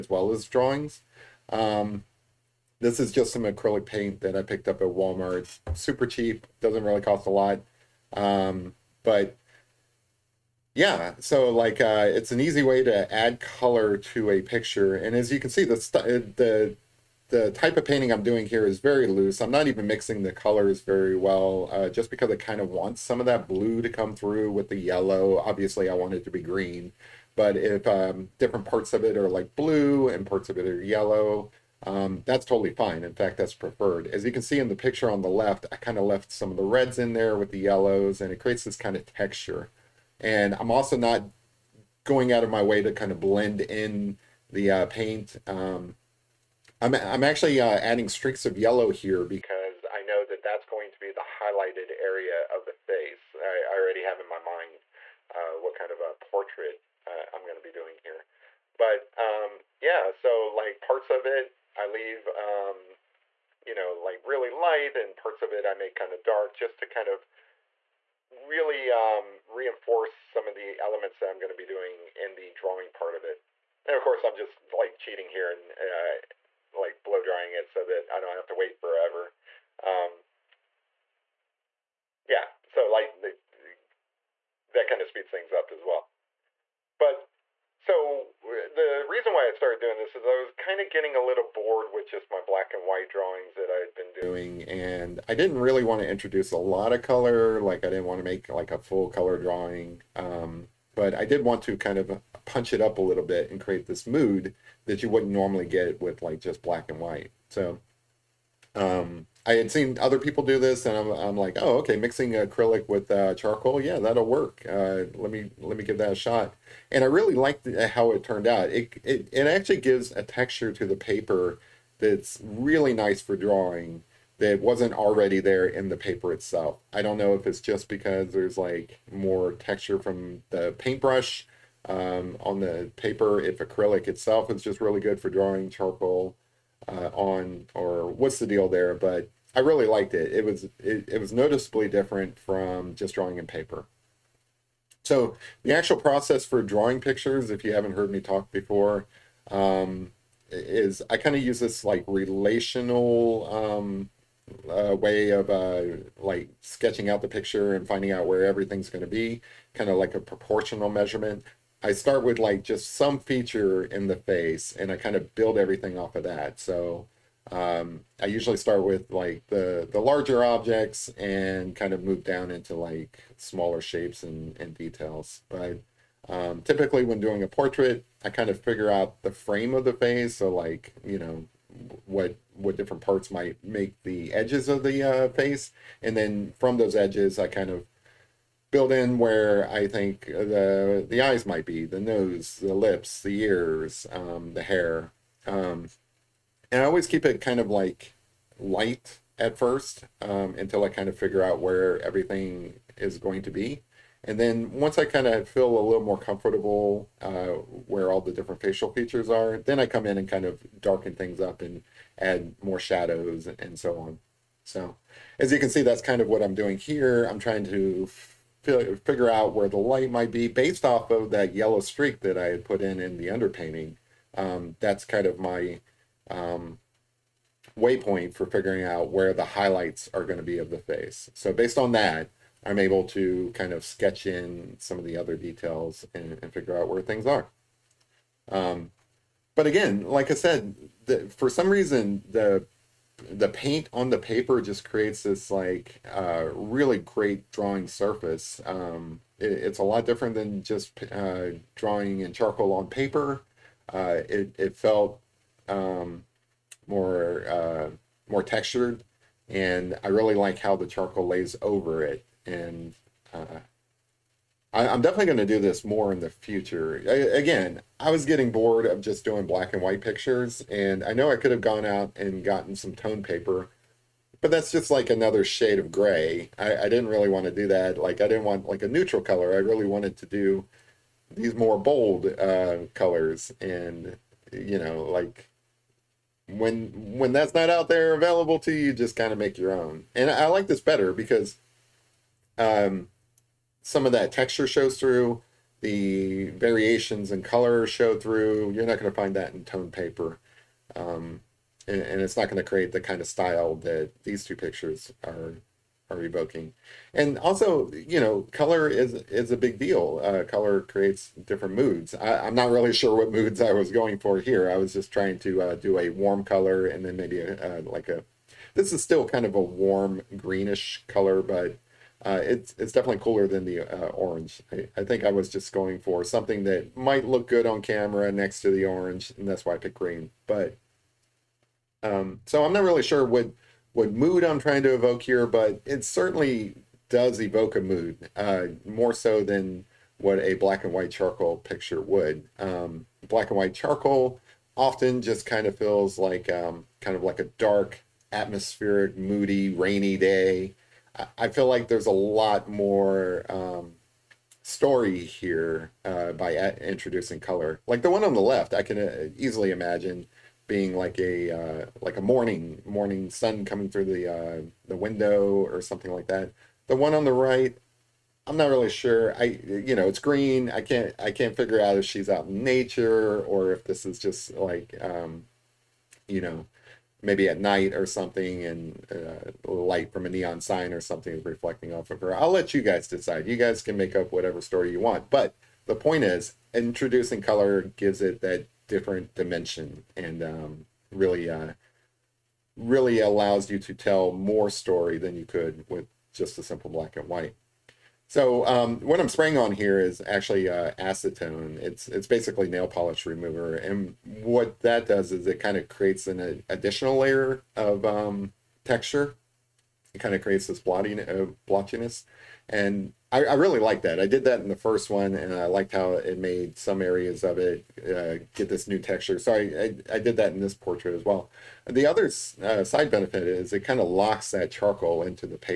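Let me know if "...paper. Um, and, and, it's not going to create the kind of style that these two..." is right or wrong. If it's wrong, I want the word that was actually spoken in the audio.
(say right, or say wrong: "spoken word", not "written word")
right.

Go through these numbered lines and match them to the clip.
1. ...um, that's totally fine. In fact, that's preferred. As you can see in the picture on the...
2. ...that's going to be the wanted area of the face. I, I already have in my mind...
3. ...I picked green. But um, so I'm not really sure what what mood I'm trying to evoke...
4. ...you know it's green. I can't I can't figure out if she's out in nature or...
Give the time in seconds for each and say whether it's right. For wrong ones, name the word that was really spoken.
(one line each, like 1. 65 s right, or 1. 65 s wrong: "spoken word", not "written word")
1. 31 s right
2. 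50 s wrong: "highlighted", not "wanted"
3. 329 s right
4. 369 s right.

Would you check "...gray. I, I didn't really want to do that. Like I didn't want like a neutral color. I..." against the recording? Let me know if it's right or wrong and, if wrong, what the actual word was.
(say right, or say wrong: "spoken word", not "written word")
right.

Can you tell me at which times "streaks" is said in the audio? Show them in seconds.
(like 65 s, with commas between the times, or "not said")
48 s, 221 s.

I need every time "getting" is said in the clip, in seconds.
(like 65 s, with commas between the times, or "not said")
90 s, 268 s.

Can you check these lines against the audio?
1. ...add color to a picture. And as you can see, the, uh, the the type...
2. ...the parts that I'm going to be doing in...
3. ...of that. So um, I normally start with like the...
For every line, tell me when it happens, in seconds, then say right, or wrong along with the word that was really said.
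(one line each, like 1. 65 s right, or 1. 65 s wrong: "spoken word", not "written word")
1. 13 s right
2. 70 s wrong: "elements", not "parts"
3. 166 s wrong: "usually", not "normally".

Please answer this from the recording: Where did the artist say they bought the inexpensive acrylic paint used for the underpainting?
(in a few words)
Walmart.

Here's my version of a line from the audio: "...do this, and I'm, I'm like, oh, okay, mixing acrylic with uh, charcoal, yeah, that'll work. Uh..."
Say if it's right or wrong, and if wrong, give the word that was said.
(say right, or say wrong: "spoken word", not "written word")
right.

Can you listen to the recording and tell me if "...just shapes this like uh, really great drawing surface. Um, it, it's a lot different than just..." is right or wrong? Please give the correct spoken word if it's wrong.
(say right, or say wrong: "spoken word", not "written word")
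wrong: "creates", not "shapes".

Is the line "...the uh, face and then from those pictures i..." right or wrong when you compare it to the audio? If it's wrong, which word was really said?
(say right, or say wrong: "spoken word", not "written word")
wrong: "edges", not "pictures".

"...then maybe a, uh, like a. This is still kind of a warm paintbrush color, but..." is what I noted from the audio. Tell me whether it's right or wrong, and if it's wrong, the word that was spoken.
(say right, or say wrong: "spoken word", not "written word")
wrong: "greenish", not "paintbrush".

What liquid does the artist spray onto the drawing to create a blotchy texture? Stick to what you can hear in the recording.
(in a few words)
Acetone.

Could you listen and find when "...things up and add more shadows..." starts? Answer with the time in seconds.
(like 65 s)
211 s.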